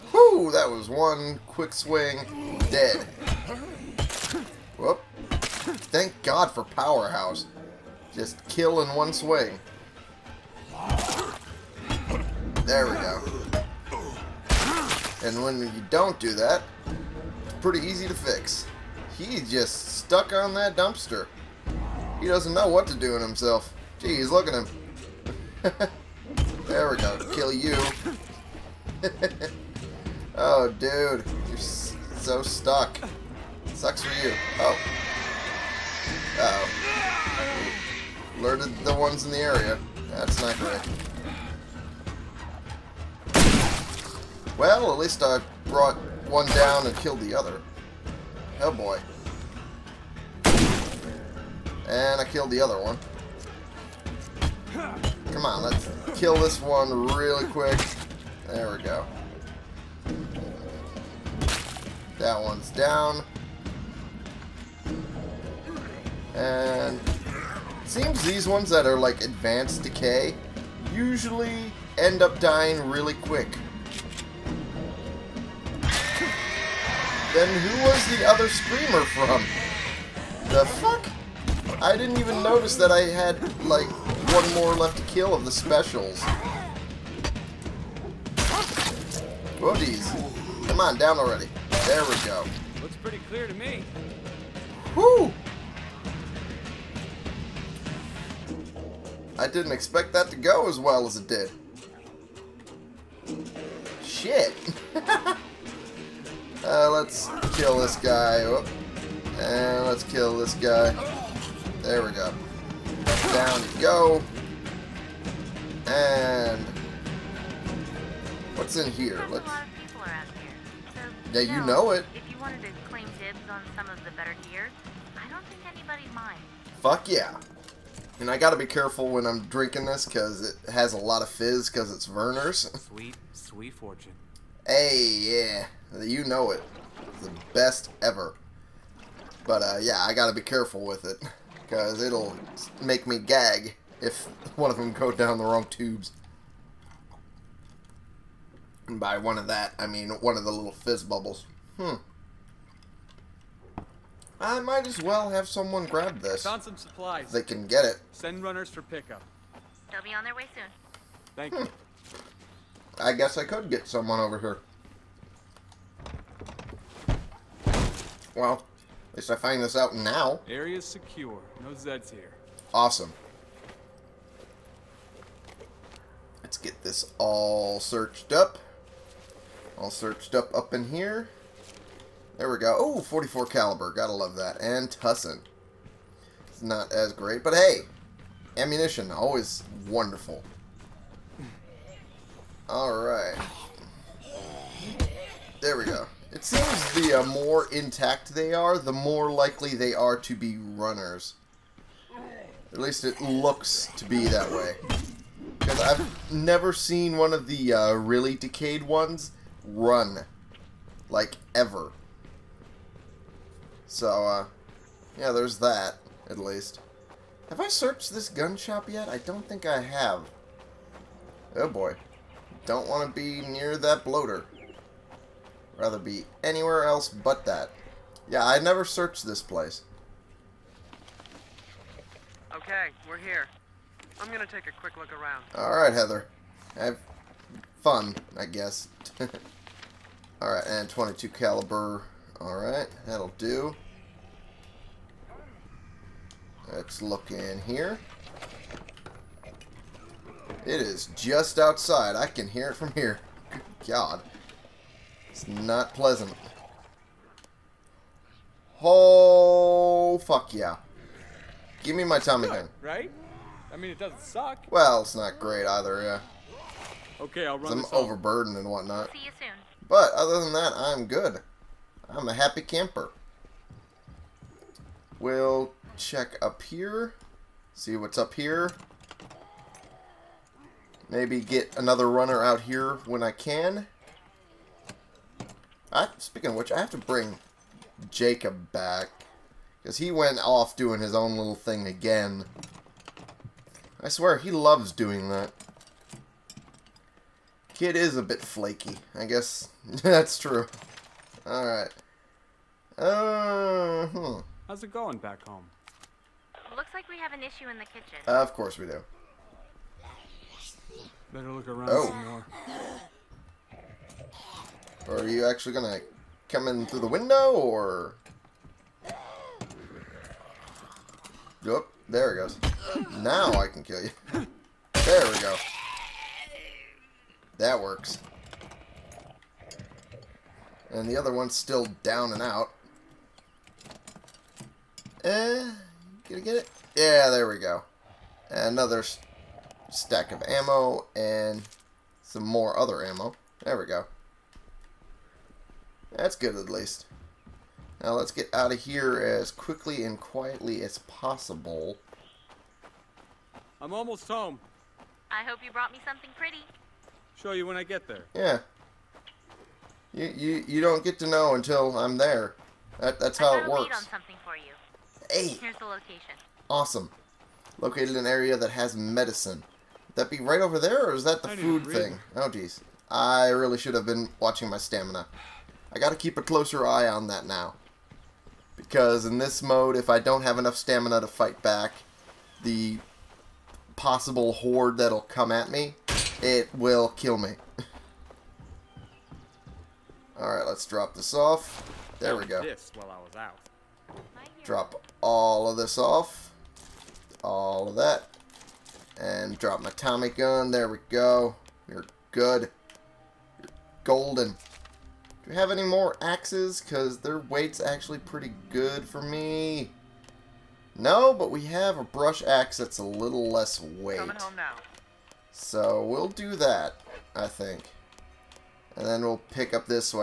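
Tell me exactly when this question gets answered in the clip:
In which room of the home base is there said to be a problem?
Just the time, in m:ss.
5:07.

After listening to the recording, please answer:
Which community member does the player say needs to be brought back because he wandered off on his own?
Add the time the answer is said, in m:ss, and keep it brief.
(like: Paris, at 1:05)
Jacob, at 4:48.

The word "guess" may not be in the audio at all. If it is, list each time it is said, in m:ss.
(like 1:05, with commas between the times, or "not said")
2:43, 3:58, 4:59.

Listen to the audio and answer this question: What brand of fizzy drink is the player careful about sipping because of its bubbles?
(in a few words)
Vernors.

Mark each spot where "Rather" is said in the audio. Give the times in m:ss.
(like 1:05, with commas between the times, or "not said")
3:45.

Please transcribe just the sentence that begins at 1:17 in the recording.
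Then who was the other screamer from?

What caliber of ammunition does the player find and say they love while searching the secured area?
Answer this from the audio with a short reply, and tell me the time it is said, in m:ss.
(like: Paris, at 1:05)
.44 caliber, at 3:02.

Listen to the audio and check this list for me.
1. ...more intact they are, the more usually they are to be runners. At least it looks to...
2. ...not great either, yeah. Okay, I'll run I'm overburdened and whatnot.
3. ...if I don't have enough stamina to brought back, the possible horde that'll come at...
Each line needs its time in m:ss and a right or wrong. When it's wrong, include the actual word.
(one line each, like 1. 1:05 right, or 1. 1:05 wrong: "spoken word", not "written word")
1. 3:17 wrong: "likely", not "usually"
2. 4:25 right
3. 6:19 wrong: "fight", not "brought".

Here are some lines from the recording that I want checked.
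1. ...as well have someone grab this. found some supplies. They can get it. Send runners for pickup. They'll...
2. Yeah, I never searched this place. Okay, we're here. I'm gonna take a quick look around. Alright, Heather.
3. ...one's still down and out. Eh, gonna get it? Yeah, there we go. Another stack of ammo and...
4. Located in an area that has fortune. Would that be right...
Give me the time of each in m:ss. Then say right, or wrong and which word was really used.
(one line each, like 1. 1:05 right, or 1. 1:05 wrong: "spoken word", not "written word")
1. 2:34 right
2. 3:48 right
3. 5:31 right
4. 6:07 wrong: "medicine", not "fortune".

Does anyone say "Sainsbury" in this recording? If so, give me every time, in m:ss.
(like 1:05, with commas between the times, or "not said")
not said.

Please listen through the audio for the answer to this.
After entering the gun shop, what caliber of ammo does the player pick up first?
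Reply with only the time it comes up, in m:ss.
4:00.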